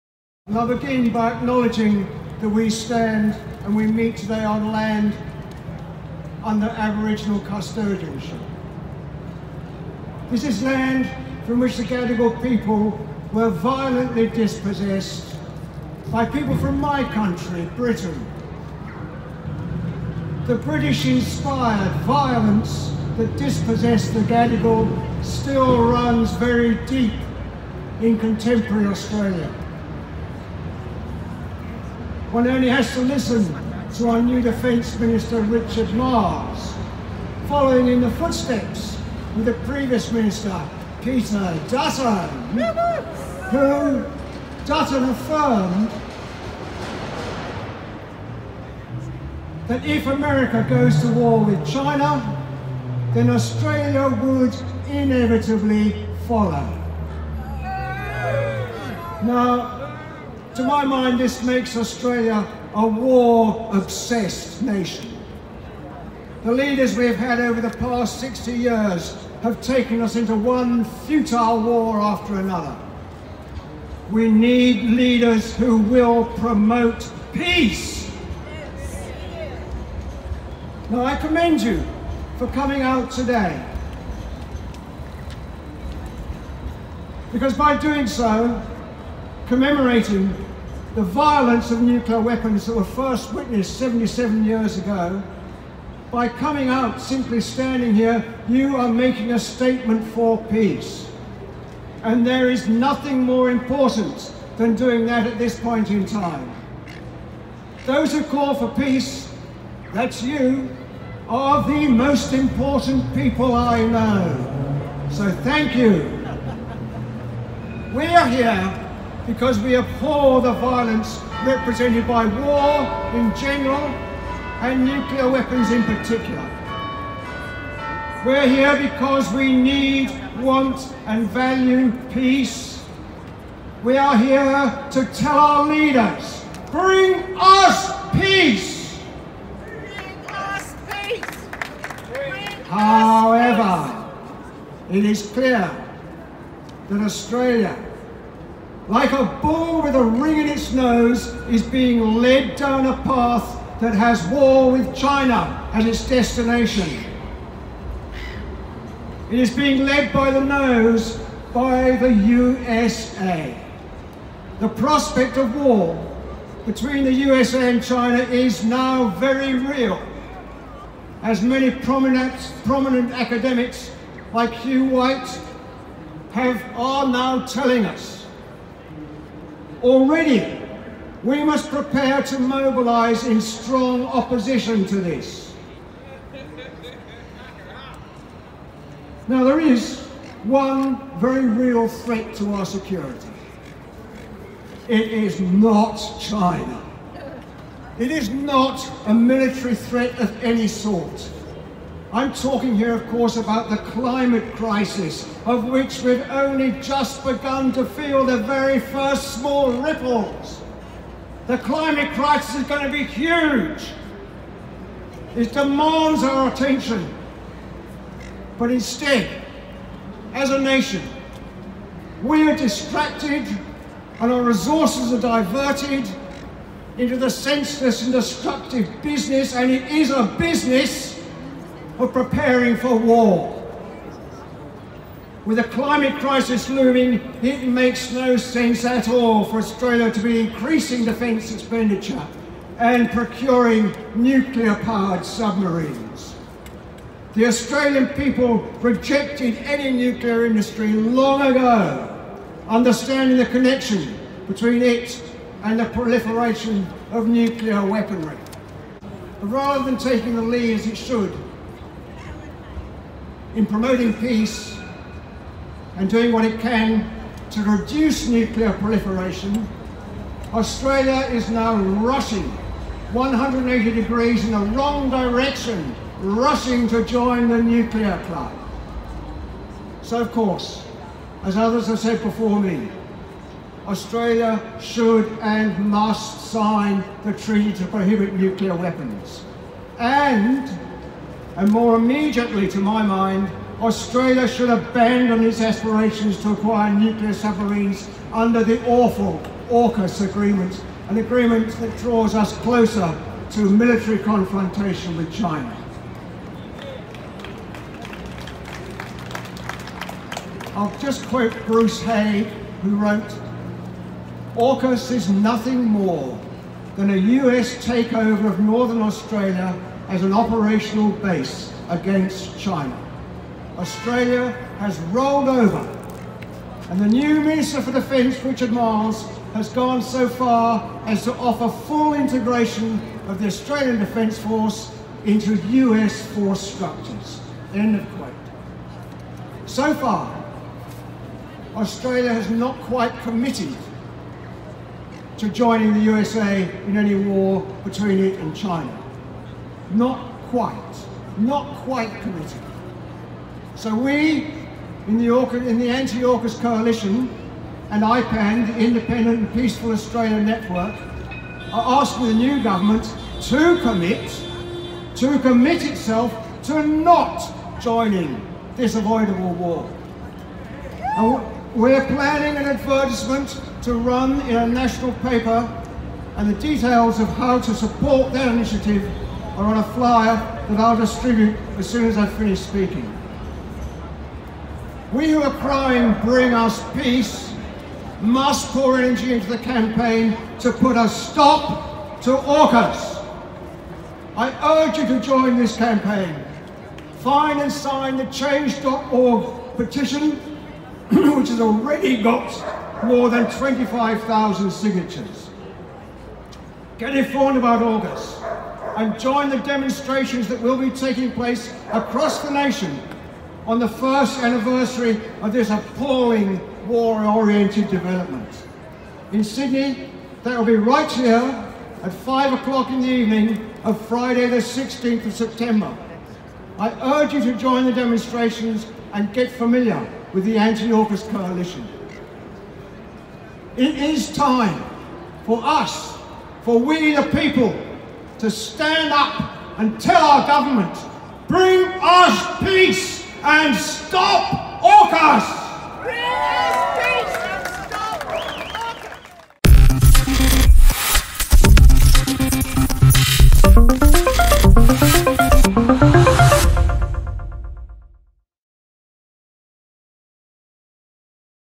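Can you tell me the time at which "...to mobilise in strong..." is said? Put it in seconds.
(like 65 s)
182 s.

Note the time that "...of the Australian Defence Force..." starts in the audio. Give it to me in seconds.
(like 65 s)
333 s.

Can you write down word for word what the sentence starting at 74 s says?
We need leaders who will promote peace.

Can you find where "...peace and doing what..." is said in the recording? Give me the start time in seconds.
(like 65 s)
264 s.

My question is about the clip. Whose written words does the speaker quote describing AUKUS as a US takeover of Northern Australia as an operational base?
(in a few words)
Bruce Haigh.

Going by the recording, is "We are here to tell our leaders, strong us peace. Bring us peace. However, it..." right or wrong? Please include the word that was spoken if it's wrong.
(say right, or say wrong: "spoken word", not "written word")
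wrong: "bring", not "strong".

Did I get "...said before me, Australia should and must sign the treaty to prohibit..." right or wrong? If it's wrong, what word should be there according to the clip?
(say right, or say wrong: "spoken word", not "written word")
right.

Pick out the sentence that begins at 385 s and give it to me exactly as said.
We who are crying, bring us peace, must pour energy into the campaign to put a stop to AUKUS.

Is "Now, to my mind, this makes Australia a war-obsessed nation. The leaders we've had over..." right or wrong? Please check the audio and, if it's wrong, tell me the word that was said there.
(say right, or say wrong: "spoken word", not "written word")
right.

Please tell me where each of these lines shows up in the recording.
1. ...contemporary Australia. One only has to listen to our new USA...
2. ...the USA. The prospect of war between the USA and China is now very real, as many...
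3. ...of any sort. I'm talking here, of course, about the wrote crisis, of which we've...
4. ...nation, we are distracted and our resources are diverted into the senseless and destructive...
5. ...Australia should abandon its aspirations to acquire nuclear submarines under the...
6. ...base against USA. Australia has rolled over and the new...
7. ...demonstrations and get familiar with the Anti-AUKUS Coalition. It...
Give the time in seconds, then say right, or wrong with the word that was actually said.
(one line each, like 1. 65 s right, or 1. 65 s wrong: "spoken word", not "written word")
1. 28 s wrong: "Defence", not "USA"
2. 161 s right
3. 200 s wrong: "climate", not "wrote"
4. 220 s right
5. 293 s right
6. 321 s wrong: "China", not "USA"
7. 427 s right.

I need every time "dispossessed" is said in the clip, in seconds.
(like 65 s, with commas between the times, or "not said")
14 s, 23 s.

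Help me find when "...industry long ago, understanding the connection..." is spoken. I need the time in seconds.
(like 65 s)
250 s.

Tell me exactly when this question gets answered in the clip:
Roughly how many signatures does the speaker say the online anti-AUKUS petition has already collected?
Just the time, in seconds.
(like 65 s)
403 s.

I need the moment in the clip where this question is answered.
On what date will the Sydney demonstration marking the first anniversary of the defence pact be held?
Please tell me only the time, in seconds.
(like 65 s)
424 s.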